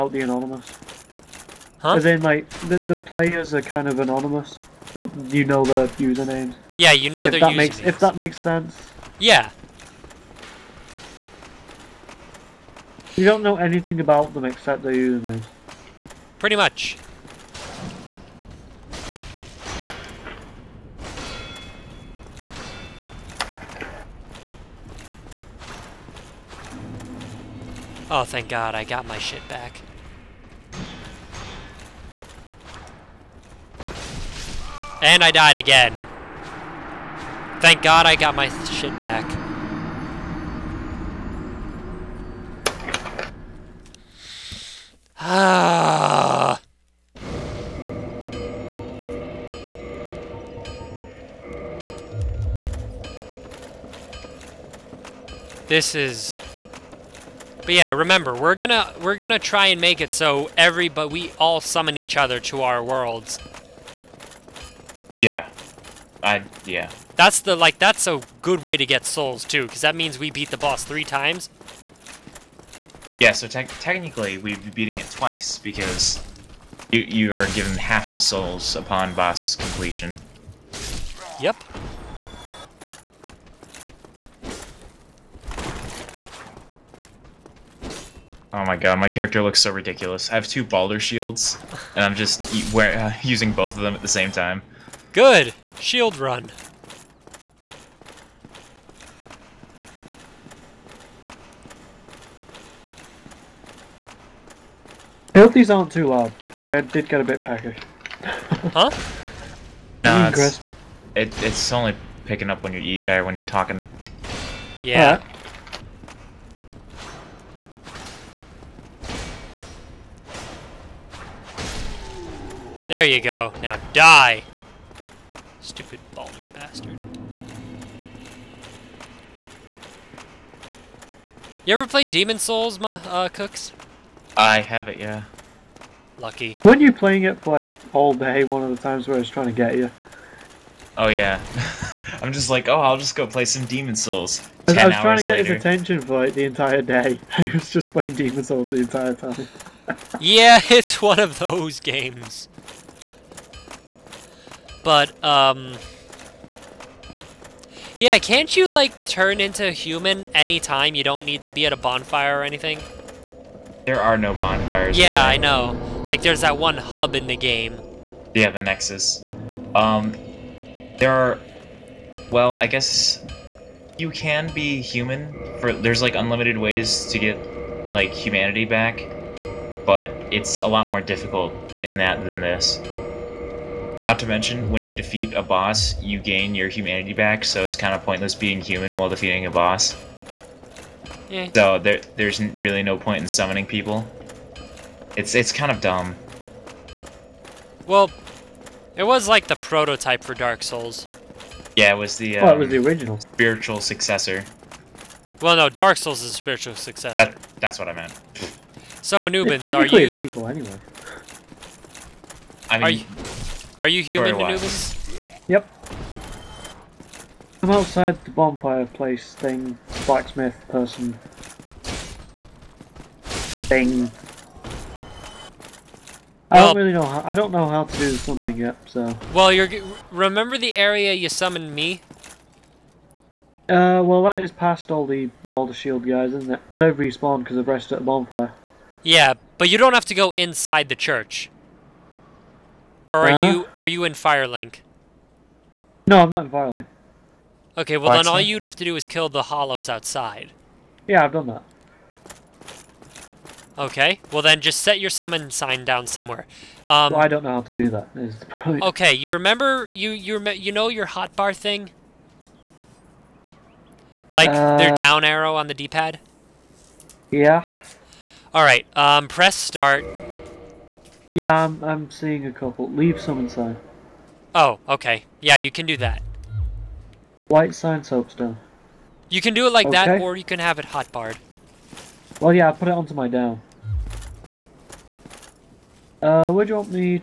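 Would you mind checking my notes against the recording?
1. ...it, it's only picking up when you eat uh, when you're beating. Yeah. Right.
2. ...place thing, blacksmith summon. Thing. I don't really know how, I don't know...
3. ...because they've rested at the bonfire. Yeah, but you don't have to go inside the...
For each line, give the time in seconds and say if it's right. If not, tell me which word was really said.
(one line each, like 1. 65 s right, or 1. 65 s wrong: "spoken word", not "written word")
1. 111 s wrong: "talking", not "beating"
2. 218 s wrong: "person", not "summon"
3. 237 s right.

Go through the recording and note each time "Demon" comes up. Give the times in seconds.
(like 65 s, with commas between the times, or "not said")
132 s, 143 s, 148 s.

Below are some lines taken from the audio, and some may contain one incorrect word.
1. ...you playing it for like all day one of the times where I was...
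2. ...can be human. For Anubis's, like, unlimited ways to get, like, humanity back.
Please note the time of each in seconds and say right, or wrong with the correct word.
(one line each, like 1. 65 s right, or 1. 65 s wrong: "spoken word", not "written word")
1. 136 s right
2. 174 s wrong: "There", not "Anubis".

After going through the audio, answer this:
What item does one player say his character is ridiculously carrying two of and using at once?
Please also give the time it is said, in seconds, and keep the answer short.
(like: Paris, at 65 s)
Balder shields, at 90 s.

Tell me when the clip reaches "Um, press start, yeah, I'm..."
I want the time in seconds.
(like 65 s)
268 s.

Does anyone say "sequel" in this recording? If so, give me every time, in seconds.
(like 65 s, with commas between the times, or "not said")
210 s.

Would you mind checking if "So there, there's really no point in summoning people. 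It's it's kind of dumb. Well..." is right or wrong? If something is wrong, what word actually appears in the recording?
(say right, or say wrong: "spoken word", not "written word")
right.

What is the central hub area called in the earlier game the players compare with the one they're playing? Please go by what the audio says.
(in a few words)
the Nexus.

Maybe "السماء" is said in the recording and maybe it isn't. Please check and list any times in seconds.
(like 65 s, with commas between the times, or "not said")
not said.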